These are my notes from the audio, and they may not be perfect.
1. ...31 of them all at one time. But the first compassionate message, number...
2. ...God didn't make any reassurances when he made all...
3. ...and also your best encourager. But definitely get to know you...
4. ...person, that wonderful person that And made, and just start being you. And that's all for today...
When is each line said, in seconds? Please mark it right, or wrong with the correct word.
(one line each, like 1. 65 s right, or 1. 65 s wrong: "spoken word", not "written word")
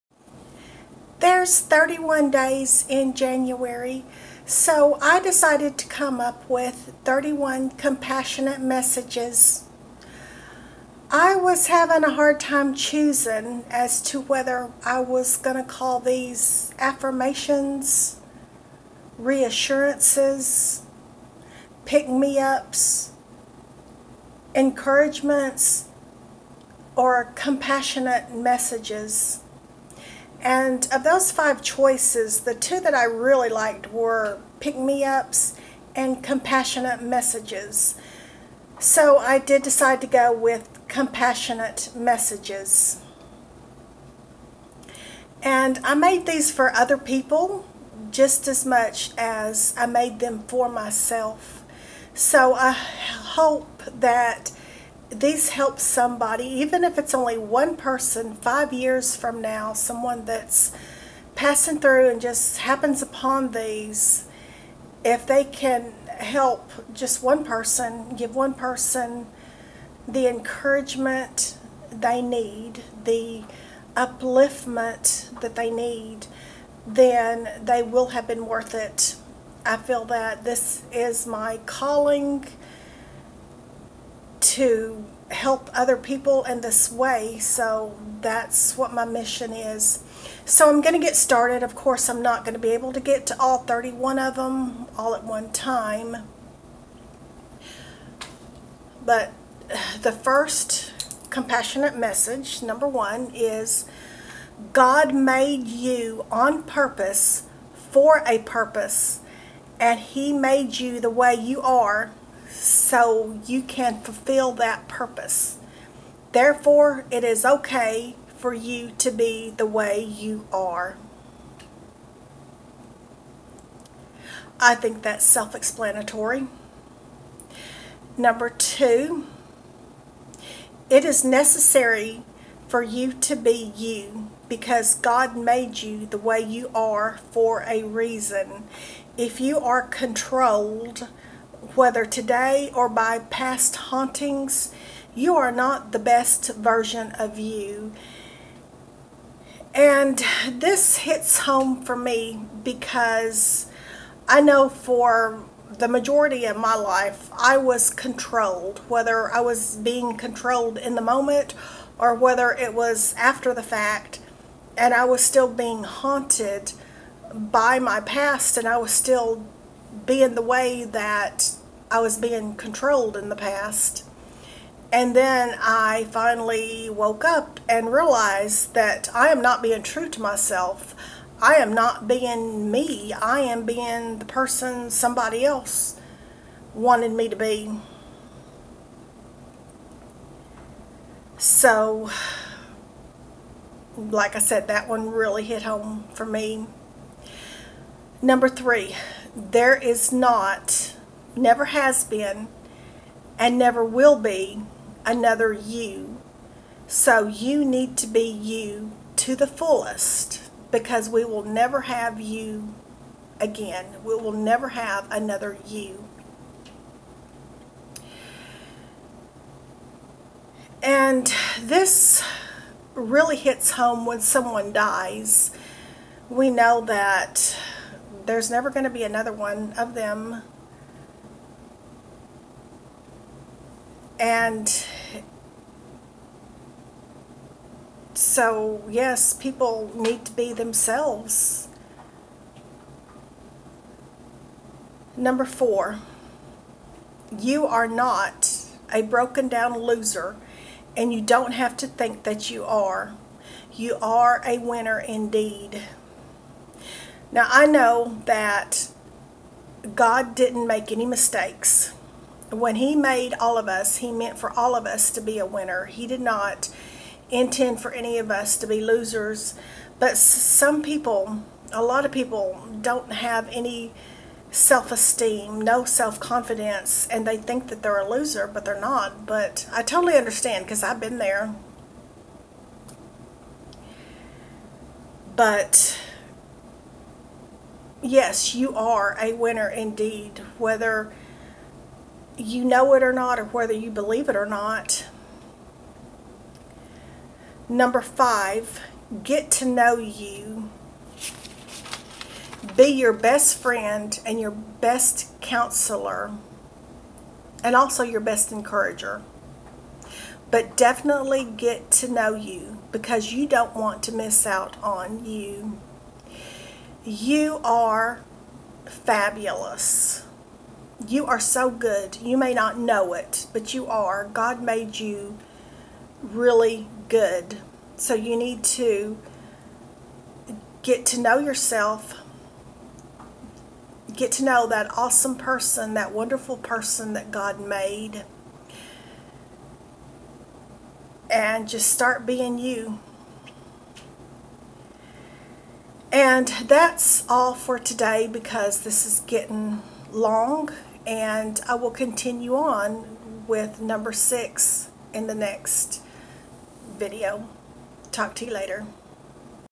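1. 93 s right
2. 259 s wrong: "mistakes", not "reassurances"
3. 307 s right
4. 335 s wrong: "God", not "And".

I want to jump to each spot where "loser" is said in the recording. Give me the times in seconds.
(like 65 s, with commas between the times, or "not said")
249 s, 268 s, 278 s.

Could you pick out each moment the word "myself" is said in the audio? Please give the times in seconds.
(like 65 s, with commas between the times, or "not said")
50 s, 180 s.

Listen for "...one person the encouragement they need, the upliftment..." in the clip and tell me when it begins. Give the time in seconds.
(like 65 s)
68 s.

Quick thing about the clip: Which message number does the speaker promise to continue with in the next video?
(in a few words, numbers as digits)
6.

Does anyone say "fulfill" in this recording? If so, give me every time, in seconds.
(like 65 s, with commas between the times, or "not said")
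114 s.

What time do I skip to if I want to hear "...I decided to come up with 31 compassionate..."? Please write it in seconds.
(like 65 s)
5 s.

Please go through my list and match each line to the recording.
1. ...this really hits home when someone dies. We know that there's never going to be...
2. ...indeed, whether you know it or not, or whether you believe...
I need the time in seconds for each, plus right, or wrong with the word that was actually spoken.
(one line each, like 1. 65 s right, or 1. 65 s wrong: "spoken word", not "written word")
1. 221 s right
2. 289 s right.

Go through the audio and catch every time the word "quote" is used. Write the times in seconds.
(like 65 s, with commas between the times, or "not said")
not said.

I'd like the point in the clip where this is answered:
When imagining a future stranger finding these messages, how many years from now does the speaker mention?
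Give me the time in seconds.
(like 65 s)
58 s.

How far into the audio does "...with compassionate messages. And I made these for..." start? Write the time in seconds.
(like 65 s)
40 s.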